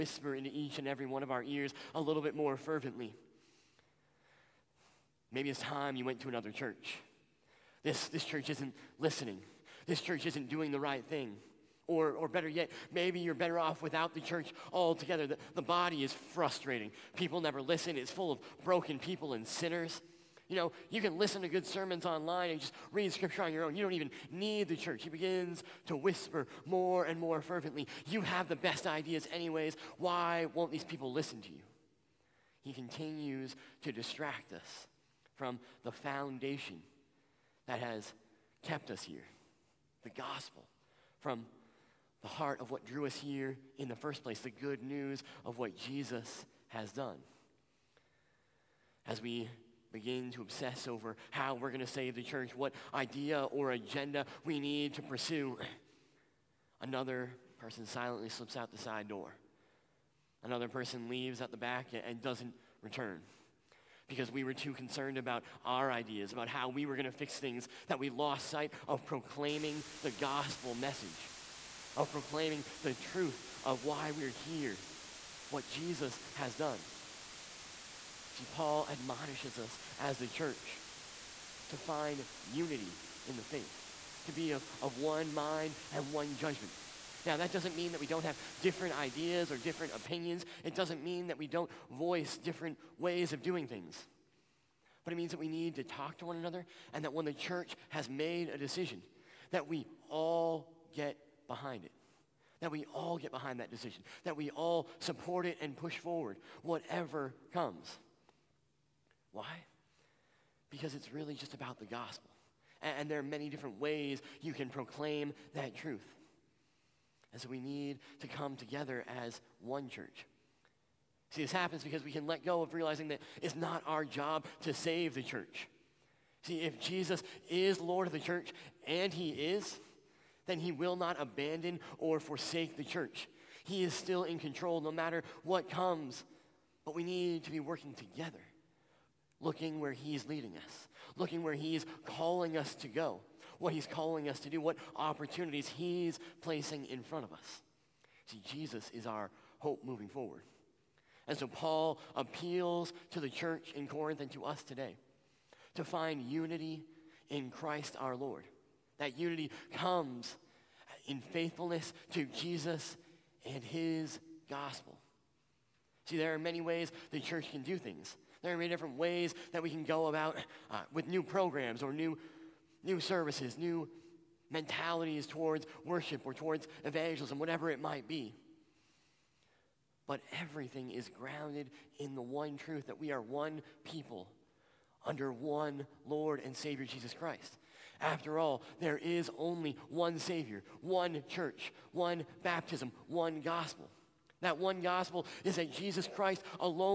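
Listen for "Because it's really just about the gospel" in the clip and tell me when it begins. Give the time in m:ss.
1:50.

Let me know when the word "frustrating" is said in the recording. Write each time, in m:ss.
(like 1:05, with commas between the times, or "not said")
0:16.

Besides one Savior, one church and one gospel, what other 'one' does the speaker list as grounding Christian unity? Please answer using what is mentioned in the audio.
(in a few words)
one baptism.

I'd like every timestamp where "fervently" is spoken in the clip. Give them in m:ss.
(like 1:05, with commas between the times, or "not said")
0:02, 0:27.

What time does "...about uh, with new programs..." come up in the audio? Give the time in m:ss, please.
2:50.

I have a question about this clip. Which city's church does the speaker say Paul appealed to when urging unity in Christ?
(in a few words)
Corinth.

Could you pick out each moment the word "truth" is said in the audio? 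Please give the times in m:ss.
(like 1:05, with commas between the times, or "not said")
1:12, 1:55, 3:02.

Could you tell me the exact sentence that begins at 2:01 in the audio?
See, this happens because we can let go of realizing that it's not our job to save the church.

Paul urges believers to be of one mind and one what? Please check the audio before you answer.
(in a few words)
judgment.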